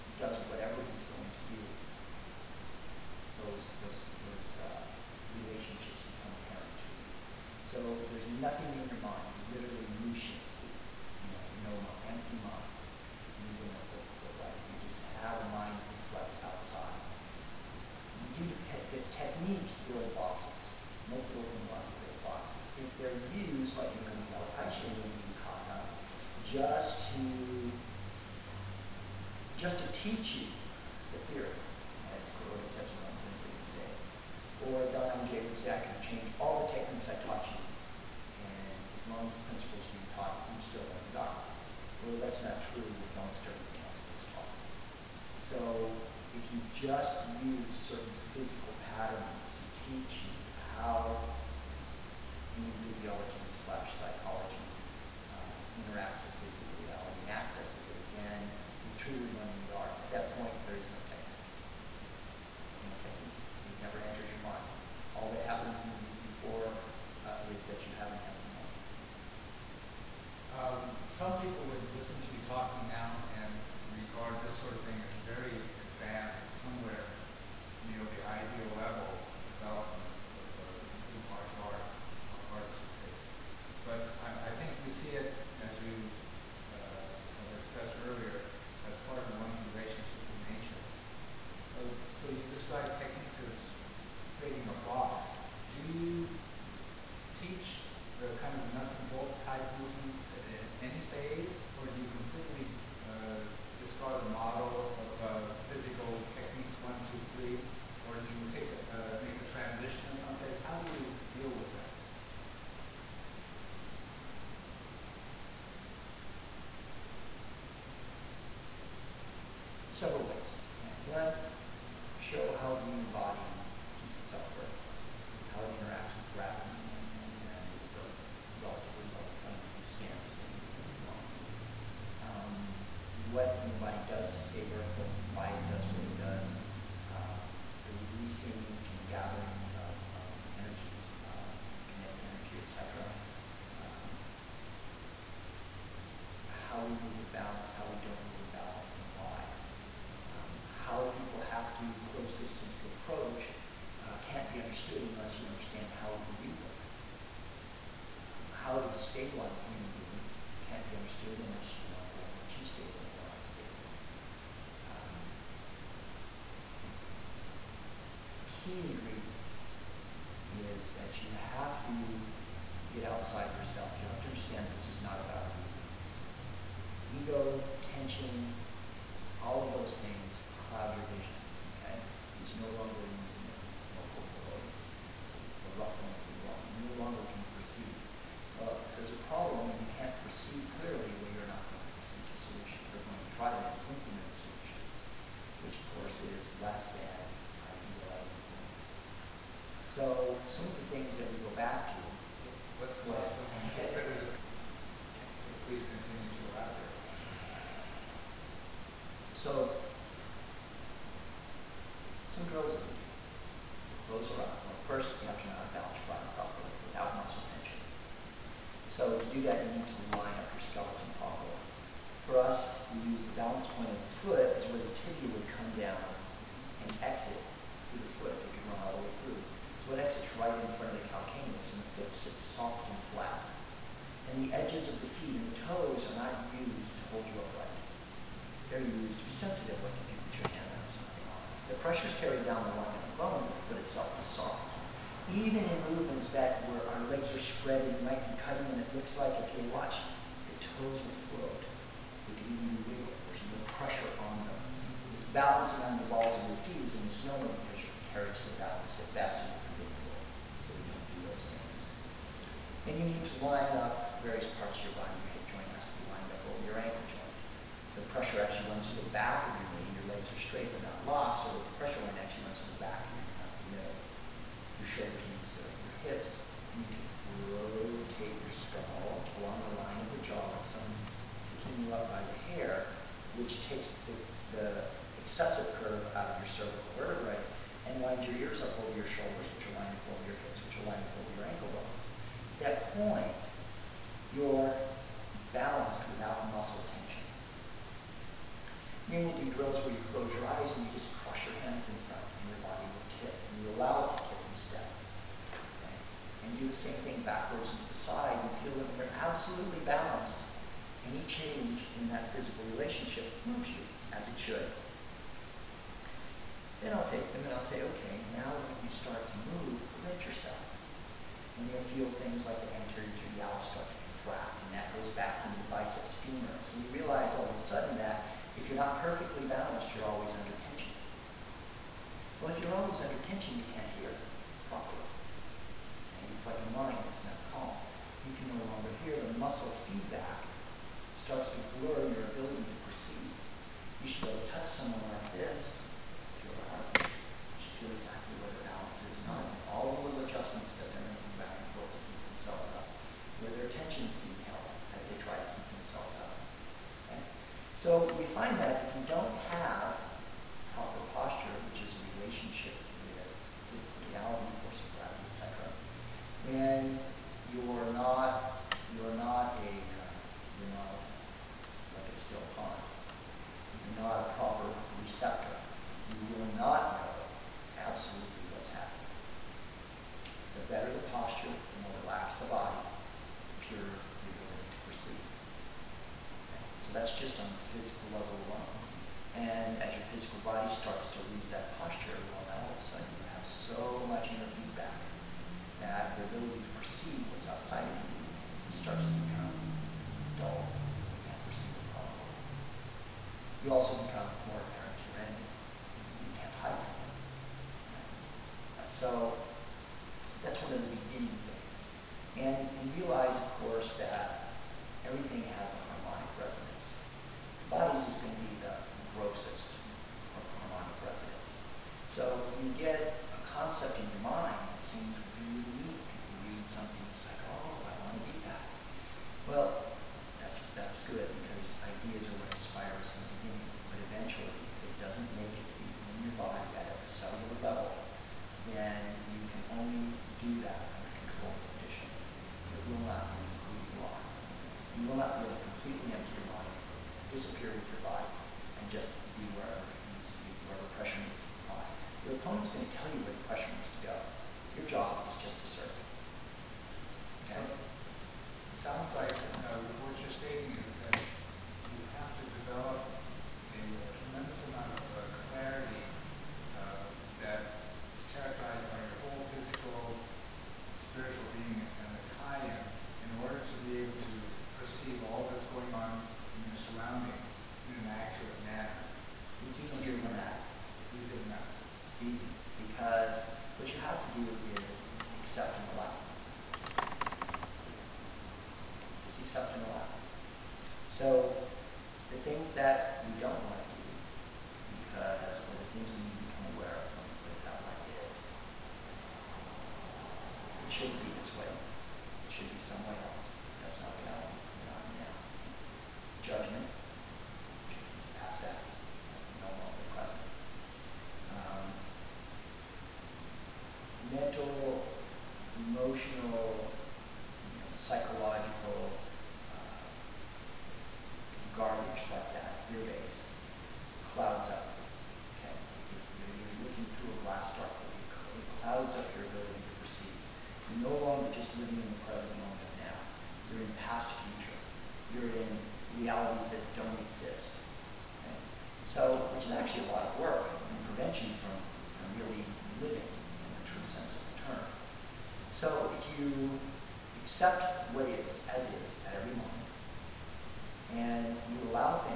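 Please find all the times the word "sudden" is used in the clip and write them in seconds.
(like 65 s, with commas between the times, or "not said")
327 s, 392 s.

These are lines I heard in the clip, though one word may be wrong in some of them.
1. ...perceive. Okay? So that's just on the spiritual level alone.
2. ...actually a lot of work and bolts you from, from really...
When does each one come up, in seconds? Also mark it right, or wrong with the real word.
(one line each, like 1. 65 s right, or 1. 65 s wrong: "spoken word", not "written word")
1. 384 s wrong: "physical", not "spiritual"
2. 539 s wrong: "prevents", not "bolts".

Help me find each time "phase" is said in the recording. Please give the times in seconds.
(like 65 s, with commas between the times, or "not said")
100 s, 110 s.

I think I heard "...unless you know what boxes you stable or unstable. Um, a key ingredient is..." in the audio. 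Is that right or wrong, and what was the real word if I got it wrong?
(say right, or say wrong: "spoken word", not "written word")
wrong: "makes", not "boxes".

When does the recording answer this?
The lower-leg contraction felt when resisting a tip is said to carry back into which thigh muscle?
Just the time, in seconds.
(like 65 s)
325 s.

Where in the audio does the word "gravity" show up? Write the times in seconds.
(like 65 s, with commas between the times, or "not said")
126 s, 364 s.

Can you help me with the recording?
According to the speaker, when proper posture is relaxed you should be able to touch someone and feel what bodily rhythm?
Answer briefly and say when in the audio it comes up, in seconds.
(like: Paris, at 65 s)
their heartbeat, at 346 s.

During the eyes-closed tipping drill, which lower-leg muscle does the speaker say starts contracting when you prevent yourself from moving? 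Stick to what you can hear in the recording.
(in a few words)
anterior tibialis.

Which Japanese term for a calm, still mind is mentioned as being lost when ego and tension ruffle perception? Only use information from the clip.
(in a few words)
mizu no kokoro.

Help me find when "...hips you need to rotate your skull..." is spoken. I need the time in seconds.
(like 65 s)
276 s.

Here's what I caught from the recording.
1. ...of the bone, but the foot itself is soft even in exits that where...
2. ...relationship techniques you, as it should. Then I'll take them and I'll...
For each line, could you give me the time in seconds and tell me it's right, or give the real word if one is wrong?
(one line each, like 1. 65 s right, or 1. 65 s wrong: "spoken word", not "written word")
1. 242 s wrong: "movements", not "exits"
2. 312 s wrong: "moves", not "techniques".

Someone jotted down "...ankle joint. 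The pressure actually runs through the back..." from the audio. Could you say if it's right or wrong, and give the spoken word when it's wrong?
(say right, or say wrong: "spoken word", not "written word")
right.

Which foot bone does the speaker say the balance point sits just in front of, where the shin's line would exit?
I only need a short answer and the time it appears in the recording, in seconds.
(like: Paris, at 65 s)
calcaneus, at 231 s.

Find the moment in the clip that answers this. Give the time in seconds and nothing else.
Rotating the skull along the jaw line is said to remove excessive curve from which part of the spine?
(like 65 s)
286 s.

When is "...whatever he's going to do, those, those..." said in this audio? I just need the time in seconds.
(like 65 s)
0 s.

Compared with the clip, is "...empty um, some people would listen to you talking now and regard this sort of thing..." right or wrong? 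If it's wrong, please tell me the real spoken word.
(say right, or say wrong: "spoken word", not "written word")
right.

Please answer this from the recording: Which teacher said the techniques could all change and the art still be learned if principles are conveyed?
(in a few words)
Kuroda Tetsuzan.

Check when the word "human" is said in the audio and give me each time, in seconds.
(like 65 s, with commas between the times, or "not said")
52 s, 122 s, 159 s.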